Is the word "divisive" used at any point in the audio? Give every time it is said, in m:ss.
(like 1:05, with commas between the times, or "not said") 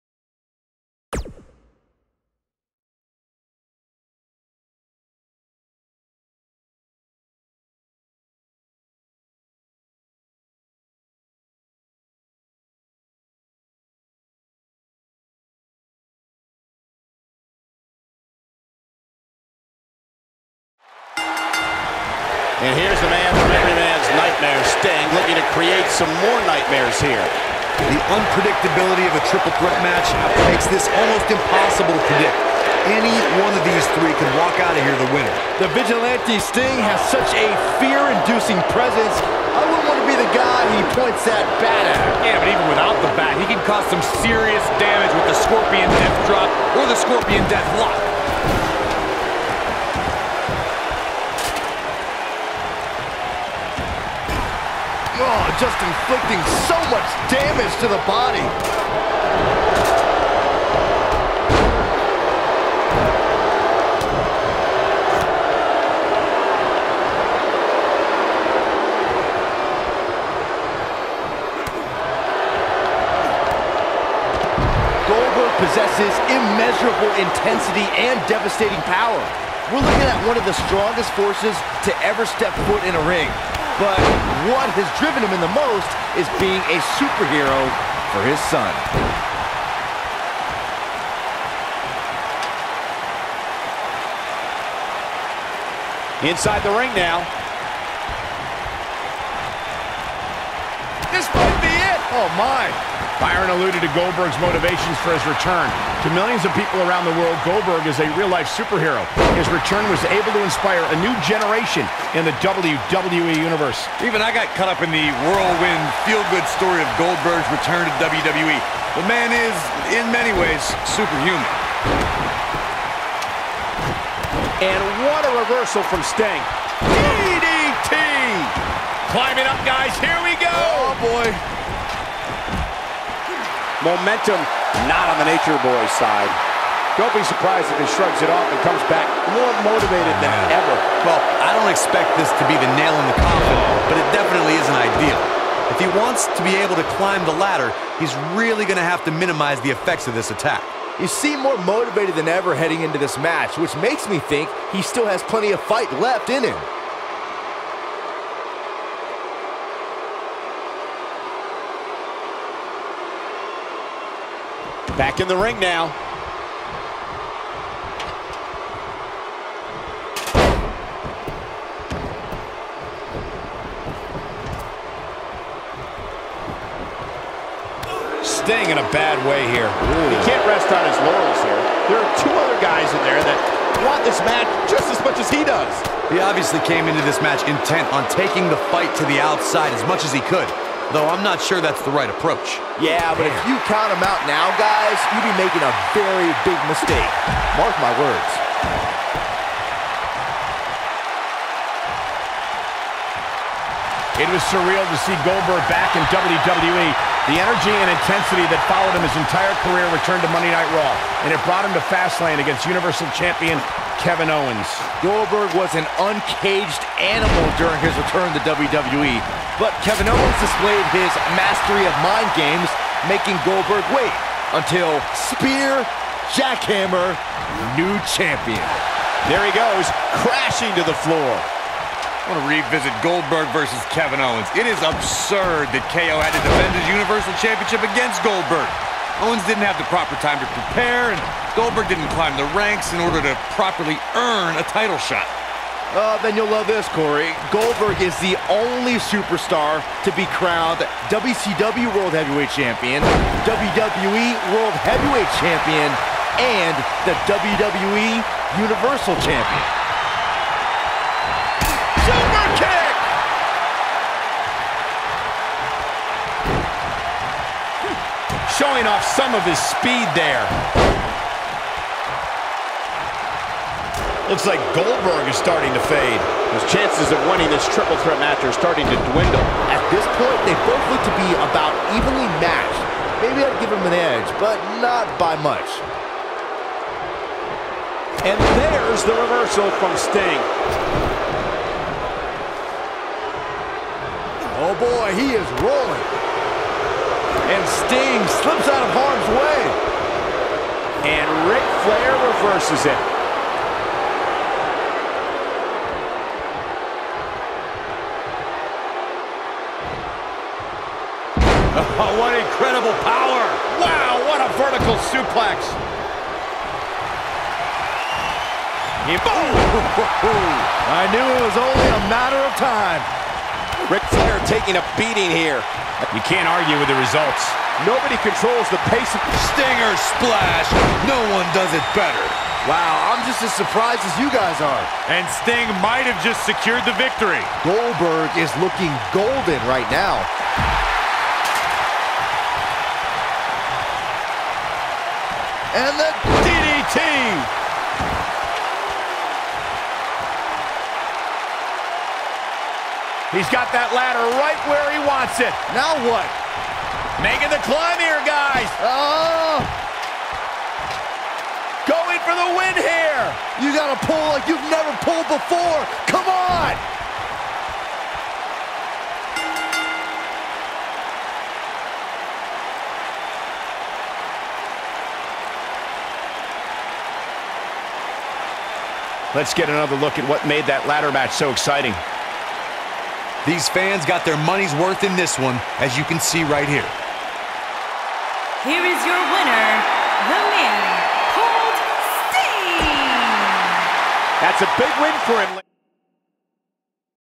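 not said.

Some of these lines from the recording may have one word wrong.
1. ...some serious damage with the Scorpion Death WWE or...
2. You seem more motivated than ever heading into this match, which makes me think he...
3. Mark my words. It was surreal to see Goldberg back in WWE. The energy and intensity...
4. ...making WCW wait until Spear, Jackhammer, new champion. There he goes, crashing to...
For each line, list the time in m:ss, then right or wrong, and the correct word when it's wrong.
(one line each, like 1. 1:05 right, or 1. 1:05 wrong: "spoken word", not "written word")
1. 0:43 wrong: "Drop", not "WWE"
2. 2:30 right
3. 3:17 right
4. 3:43 wrong: "Goldberg", not "WCW".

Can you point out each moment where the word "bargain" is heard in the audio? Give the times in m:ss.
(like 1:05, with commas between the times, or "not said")
not said.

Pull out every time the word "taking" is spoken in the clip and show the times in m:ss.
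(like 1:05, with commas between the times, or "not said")
3:08, 5:24.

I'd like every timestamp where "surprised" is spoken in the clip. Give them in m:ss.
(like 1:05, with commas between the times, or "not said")
2:17, 5:33.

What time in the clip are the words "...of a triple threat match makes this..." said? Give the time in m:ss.
0:29.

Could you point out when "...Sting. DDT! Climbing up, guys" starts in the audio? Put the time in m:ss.
2:06.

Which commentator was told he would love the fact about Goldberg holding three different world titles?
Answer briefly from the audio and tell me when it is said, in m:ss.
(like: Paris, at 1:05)
Corey, at 4:06.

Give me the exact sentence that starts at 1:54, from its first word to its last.
Even I got caught up in the whirlwind, feel-good story of Goldberg's return to WWE.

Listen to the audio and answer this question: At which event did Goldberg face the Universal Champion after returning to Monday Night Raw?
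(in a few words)
Fastlane.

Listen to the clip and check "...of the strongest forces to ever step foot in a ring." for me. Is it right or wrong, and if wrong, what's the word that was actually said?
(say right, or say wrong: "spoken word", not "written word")
right.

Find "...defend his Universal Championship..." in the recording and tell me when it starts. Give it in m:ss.
3:56.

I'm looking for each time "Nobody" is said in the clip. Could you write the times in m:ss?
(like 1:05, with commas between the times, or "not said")
5:27.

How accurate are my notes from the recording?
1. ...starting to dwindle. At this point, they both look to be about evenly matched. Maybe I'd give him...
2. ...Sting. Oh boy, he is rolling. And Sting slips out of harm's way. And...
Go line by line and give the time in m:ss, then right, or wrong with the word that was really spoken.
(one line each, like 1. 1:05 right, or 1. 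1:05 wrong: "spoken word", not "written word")
1. 4:38 right
2. 4:49 right.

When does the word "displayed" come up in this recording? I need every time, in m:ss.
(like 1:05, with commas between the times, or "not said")
3:40.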